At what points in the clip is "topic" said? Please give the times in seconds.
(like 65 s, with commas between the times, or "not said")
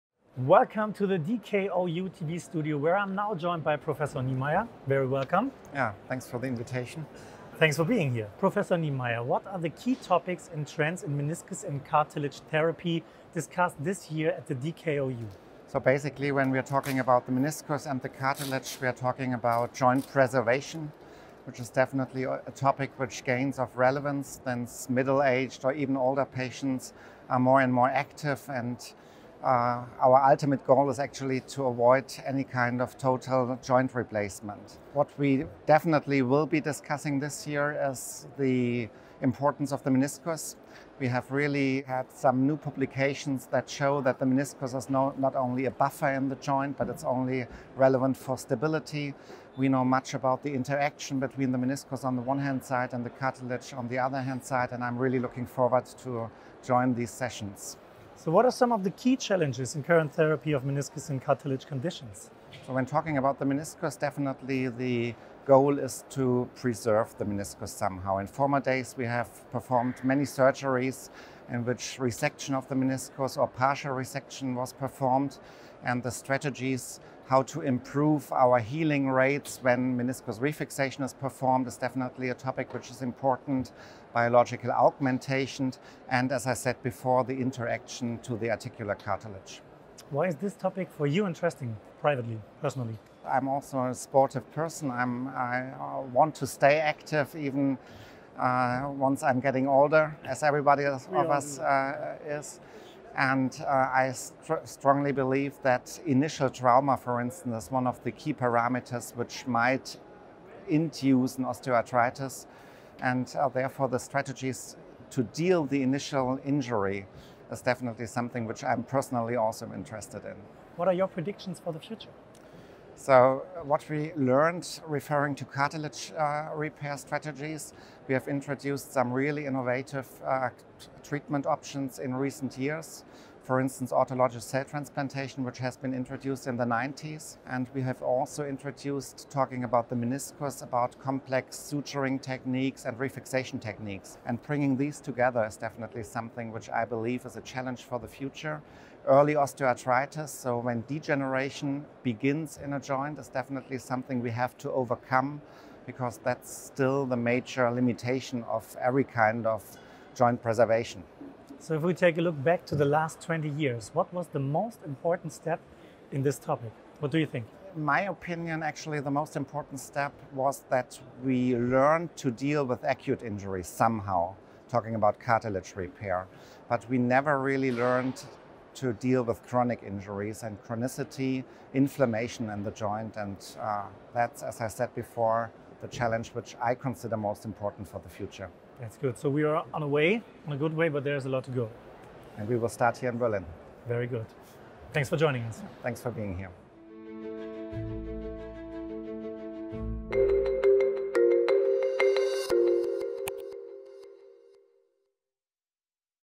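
9 s, 22 s, 82 s, 90 s, 166 s.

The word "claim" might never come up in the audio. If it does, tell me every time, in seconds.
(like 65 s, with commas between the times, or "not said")
not said.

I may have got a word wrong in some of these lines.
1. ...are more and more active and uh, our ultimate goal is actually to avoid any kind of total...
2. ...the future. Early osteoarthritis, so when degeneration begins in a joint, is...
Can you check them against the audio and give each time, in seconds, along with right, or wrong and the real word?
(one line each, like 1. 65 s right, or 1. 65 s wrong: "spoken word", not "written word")
1. 27 s right
2. 147 s right.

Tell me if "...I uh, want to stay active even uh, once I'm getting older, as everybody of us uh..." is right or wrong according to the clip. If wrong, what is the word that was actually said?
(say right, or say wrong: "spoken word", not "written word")
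right.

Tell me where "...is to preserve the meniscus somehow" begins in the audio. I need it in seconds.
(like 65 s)
65 s.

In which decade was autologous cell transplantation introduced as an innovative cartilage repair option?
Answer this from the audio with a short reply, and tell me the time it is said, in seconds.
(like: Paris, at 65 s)
the 90s, at 136 s.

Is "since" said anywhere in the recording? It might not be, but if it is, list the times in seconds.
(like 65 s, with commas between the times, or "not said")
24 s.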